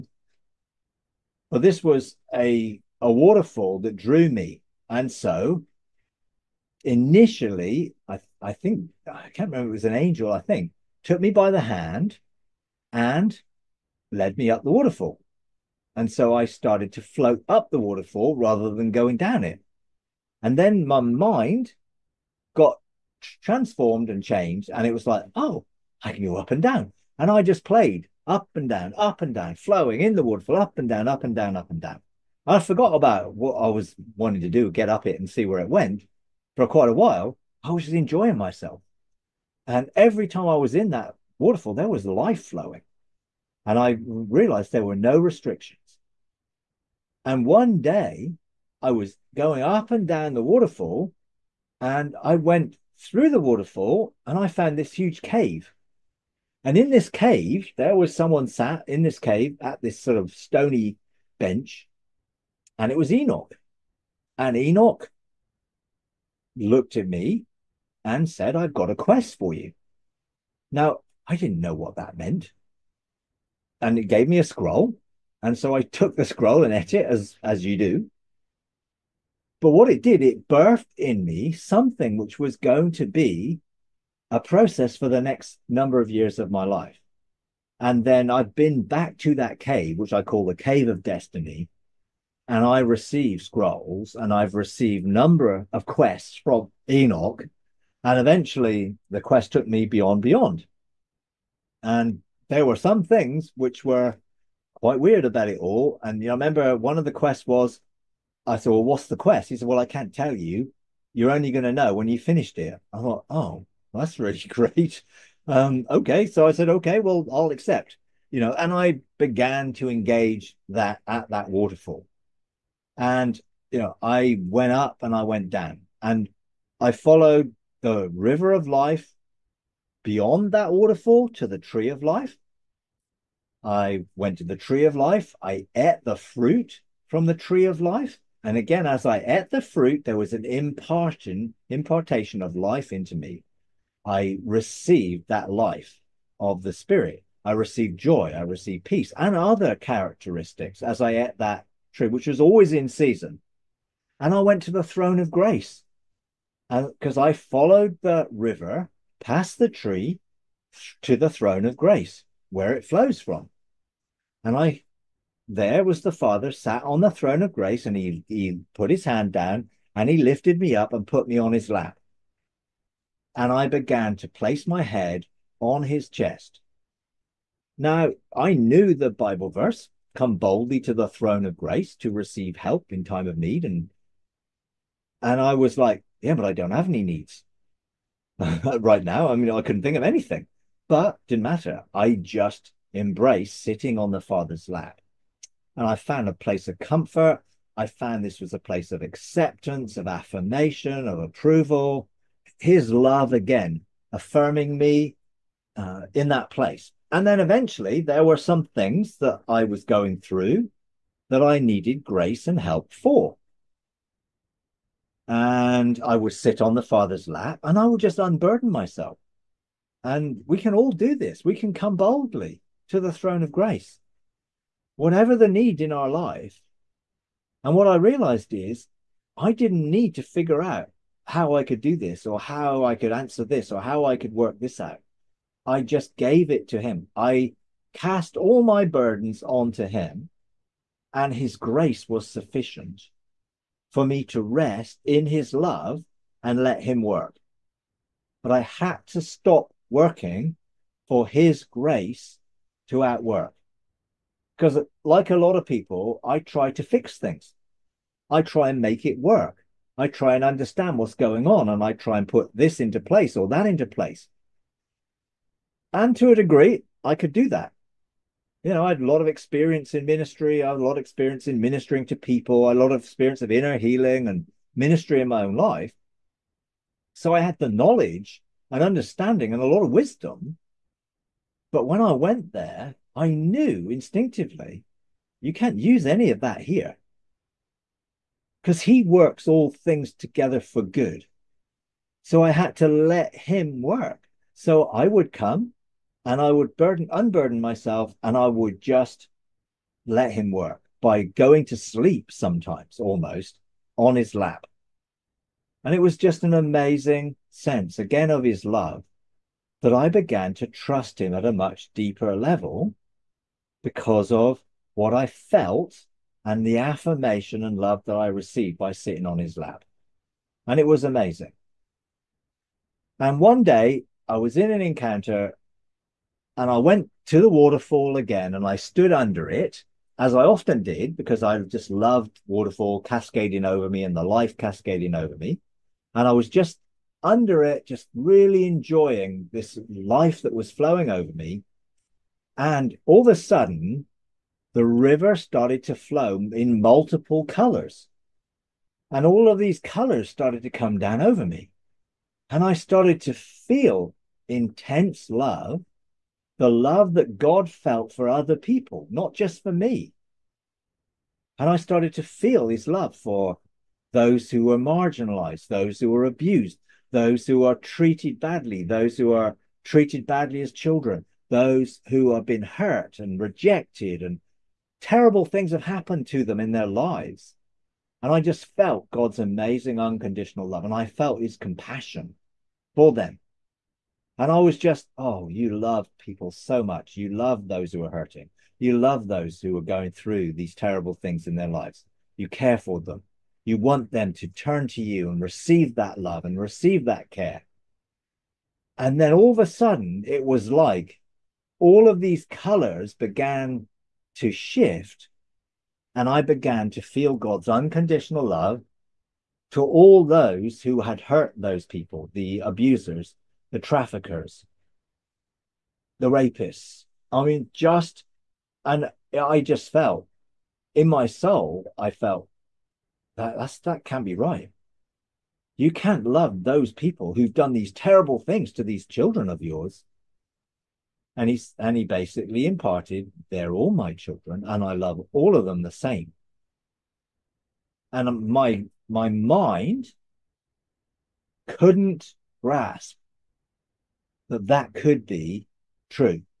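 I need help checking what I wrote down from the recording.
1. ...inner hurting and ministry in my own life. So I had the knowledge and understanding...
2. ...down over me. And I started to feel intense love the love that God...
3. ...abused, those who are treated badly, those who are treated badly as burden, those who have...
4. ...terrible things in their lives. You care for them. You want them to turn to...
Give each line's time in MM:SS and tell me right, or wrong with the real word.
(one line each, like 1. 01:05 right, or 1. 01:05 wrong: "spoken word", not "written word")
1. 04:33 wrong: "healing", not "hurting"
2. 05:50 right
3. 06:06 wrong: "children", not "burden"
4. 06:30 right.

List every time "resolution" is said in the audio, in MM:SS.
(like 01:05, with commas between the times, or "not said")
not said.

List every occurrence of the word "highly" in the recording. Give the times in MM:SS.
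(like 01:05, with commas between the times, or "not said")
not said.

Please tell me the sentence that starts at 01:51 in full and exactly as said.
You're only going to know when you finished it.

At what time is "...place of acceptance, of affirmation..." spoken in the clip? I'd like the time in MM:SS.
03:18.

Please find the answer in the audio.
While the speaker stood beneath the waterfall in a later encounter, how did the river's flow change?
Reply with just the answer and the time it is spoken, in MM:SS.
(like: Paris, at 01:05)
Multiple colors, at 05:46.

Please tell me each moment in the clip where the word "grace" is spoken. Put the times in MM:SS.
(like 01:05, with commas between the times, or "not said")
02:35, 02:41, 02:47, 03:01, 03:32, 03:43, 04:01, 04:11.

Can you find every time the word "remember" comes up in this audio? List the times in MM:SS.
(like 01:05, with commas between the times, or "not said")
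00:09, 01:46.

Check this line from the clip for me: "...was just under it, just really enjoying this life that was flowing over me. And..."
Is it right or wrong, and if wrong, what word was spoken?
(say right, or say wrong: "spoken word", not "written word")
right.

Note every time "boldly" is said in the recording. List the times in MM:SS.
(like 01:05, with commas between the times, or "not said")
03:00, 03:41.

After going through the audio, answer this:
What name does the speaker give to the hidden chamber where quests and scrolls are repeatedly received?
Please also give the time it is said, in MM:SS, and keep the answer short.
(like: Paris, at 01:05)
Cave of destiny, at 01:30.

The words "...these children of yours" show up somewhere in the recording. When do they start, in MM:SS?
07:08.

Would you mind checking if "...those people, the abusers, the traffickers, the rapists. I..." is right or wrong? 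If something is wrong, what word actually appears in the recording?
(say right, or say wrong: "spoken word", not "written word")
right.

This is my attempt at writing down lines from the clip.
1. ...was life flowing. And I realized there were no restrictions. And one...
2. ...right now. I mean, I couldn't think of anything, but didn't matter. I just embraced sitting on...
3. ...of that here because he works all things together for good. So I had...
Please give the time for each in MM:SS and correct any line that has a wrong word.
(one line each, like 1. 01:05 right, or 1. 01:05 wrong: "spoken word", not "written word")
1. 00:41 right
2. 03:08 right
3. 04:46 right.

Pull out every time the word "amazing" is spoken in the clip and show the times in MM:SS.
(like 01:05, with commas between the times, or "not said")
05:06, 05:21, 06:19.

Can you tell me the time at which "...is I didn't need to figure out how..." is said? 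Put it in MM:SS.
03:48.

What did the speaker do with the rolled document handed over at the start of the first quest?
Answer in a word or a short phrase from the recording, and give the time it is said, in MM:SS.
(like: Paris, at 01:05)
Ate it, at 01:16.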